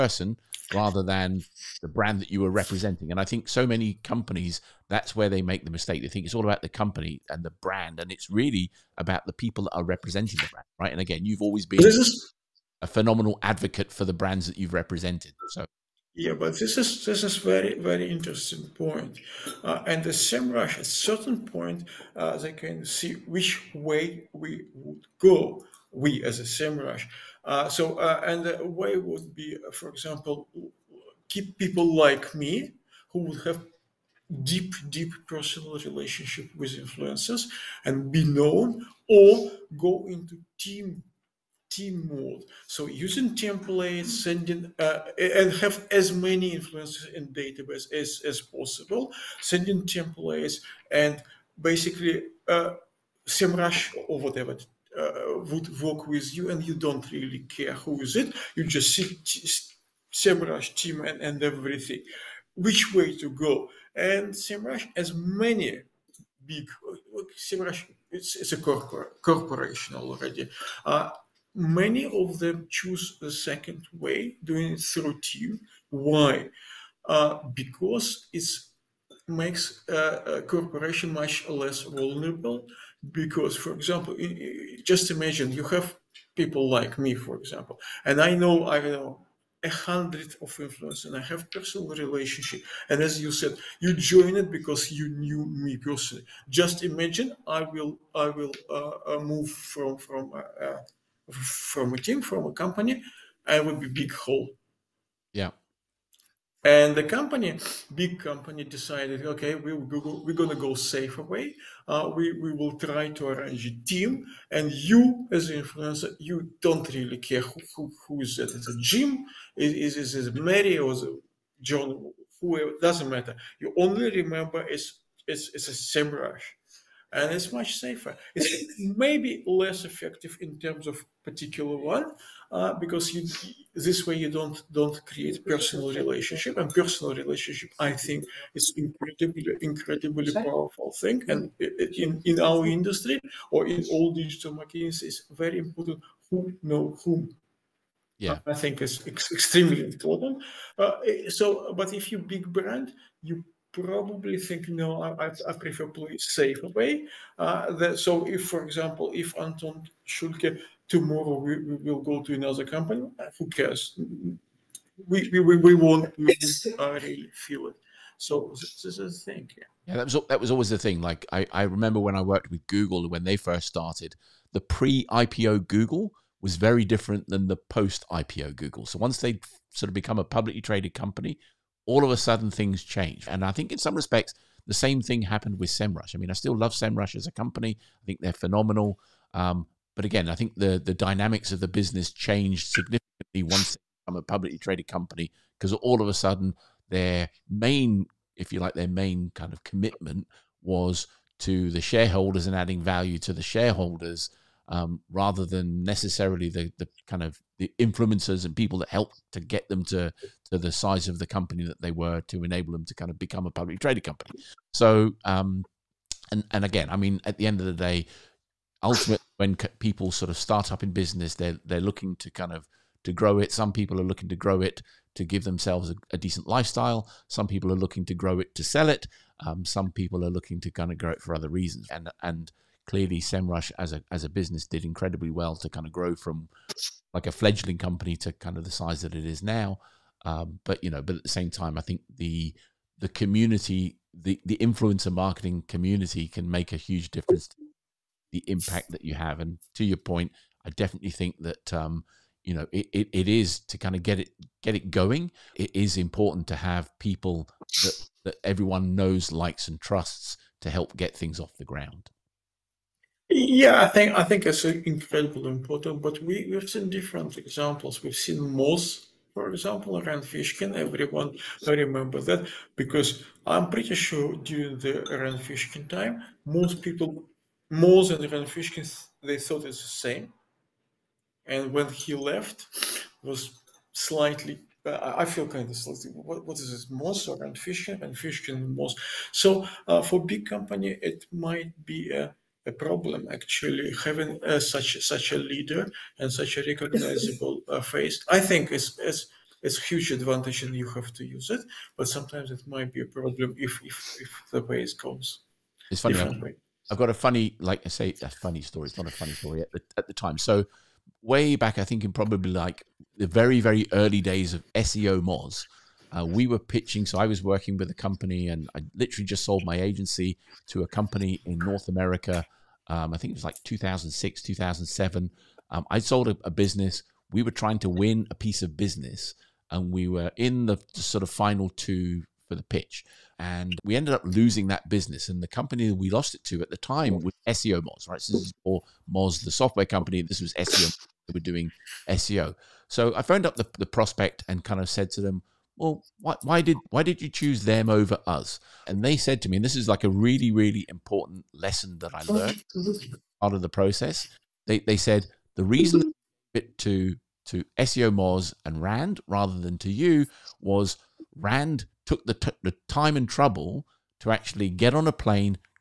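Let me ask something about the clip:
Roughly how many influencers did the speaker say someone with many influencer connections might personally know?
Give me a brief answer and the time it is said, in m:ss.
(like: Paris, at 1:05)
100, at 1:29.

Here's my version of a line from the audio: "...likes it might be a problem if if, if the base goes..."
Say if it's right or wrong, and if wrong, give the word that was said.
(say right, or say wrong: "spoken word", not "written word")
wrong: "sometimes", not "likes".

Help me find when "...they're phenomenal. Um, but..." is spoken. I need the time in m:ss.
3:08.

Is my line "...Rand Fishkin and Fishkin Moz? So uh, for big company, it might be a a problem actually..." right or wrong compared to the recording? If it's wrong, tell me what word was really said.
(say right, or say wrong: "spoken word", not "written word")
right.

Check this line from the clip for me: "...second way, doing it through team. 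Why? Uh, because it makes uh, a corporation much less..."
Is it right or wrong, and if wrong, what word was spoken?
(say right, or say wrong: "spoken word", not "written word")
right.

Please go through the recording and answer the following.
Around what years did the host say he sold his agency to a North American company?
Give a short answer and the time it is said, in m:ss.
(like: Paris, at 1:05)
2006 or 2007, at 5:23.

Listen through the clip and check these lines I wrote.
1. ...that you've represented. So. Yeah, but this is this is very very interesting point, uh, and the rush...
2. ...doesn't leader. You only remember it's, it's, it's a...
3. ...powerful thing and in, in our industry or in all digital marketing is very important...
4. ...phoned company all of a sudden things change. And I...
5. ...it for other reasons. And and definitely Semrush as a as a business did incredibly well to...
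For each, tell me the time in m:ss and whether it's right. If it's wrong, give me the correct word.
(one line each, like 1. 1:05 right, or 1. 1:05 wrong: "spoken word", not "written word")
1. 0:14 right
2. 2:02 wrong: "matter", not "leader"
3. 2:20 right
4. 3:00 wrong: "traded", not "phoned"
5. 3:51 wrong: "clearly", not "definitely".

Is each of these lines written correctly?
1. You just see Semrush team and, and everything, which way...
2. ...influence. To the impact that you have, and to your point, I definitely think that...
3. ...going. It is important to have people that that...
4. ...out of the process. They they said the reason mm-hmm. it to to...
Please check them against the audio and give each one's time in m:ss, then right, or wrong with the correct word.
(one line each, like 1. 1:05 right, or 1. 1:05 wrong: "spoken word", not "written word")
1. 0:58 right
2. 4:07 wrong: "difference", not "influence"
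3. 4:14 right
4. 5:53 right.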